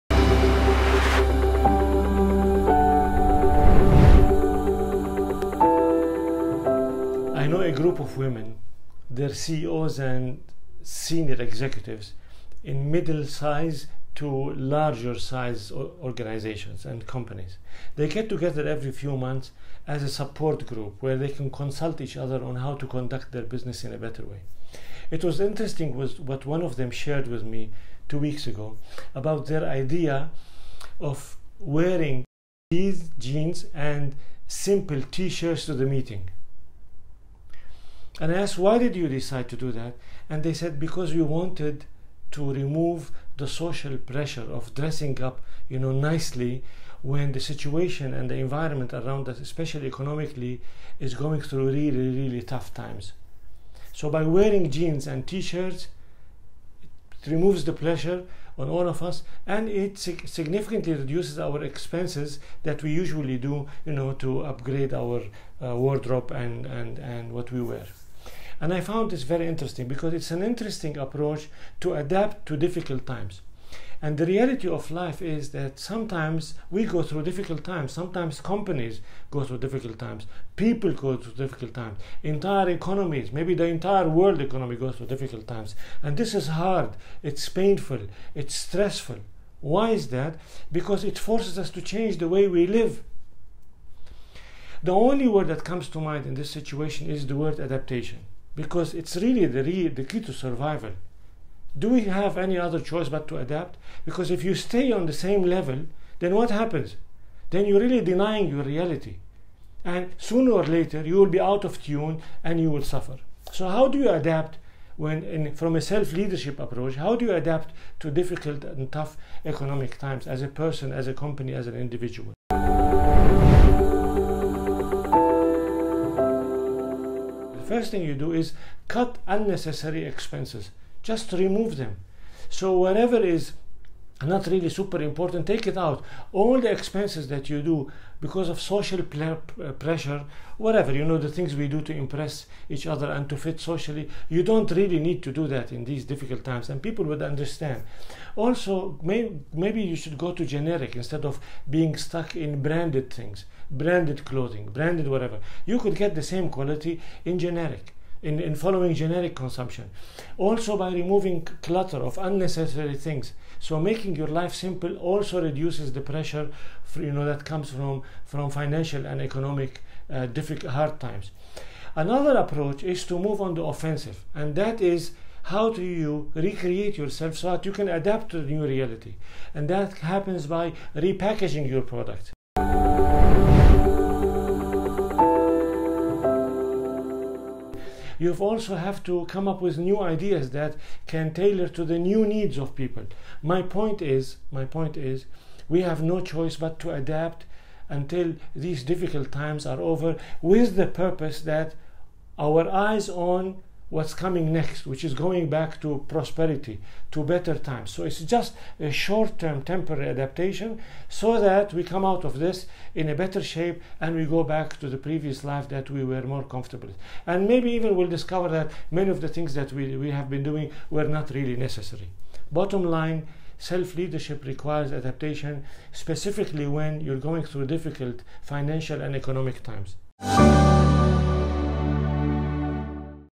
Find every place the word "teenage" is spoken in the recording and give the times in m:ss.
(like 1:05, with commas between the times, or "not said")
not said.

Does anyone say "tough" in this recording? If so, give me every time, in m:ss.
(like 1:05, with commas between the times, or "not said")
0:52, 1:58.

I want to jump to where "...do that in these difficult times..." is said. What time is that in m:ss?
2:25.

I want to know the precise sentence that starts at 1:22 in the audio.
Entire economies, maybe the entire world economy goes through difficult times.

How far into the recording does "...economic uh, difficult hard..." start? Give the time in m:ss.
2:49.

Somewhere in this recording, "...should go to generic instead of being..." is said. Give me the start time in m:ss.
2:29.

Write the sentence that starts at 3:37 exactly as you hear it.
And maybe even we'll discover that many of the things that we, we have been doing were not really necessary.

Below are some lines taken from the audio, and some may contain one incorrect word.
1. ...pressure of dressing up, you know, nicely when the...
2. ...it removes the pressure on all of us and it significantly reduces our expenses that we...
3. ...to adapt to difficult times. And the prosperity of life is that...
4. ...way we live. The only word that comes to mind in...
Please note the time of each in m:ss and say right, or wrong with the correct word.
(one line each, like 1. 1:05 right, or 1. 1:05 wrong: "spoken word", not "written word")
1. 0:43 right
2. 0:57 right
3. 1:11 wrong: "reality", not "prosperity"
4. 1:32 right.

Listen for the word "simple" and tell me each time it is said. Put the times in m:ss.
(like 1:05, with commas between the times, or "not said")
0:34, 2:44.